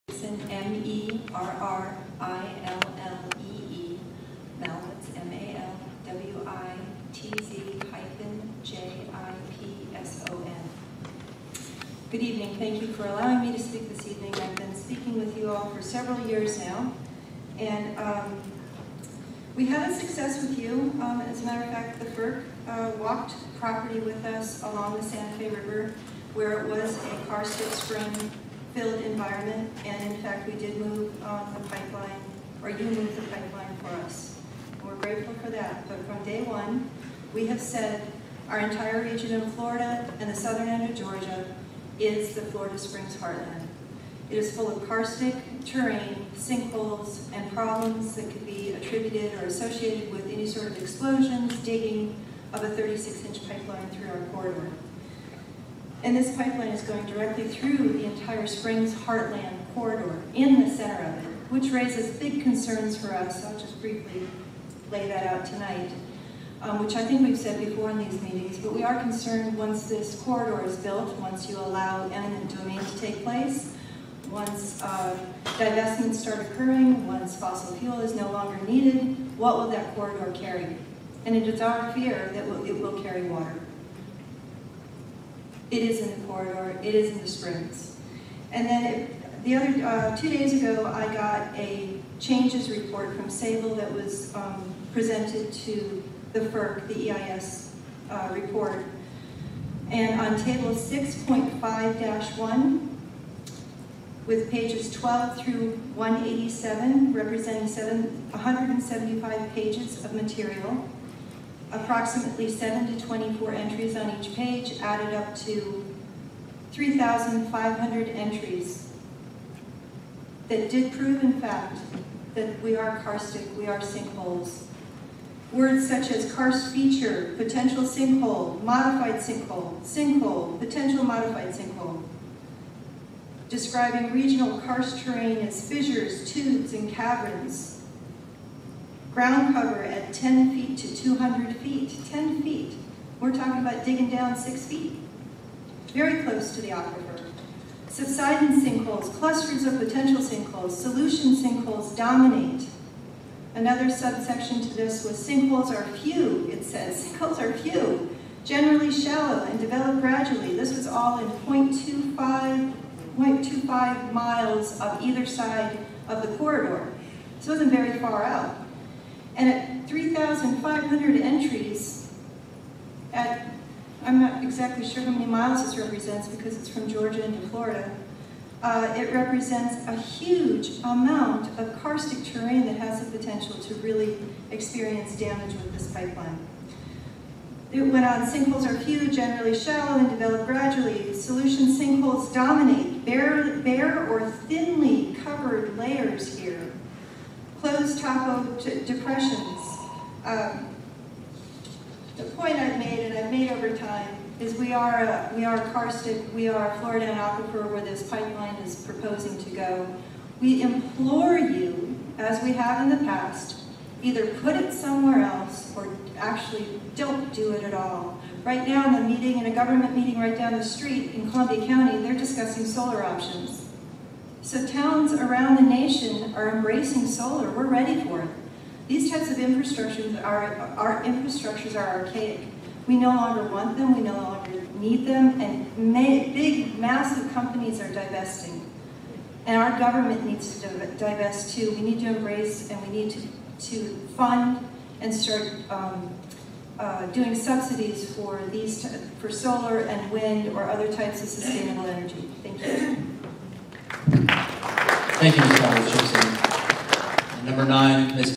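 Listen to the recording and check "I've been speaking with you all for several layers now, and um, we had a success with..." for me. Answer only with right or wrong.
wrong.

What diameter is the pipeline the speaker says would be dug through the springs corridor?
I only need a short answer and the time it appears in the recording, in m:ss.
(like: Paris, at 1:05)
36-inch, at 0:52.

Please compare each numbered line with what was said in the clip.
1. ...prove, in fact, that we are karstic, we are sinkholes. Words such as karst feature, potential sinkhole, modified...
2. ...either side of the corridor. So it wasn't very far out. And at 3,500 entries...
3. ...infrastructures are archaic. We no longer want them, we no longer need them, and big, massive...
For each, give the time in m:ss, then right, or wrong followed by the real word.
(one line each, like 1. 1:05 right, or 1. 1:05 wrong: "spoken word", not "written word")
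1. 2:00 right
2. 2:45 right
3. 3:51 right.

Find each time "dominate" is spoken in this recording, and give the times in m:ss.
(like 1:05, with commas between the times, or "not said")
2:31, 3:12.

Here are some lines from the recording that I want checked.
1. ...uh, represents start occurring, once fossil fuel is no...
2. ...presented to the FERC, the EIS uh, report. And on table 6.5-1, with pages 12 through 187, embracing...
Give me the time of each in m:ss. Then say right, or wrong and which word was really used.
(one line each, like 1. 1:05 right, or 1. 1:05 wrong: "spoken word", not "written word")
1. 1:14 wrong: "divestments", not "represents"
2. 1:34 wrong: "representing", not "embracing".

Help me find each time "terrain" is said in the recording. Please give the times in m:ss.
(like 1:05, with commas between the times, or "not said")
0:45, 2:15, 3:02.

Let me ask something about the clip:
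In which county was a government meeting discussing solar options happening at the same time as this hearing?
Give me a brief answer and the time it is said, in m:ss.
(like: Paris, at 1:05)
Columbia County, at 3:41.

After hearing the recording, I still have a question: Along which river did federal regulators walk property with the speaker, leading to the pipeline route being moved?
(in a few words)
Santa Fe River.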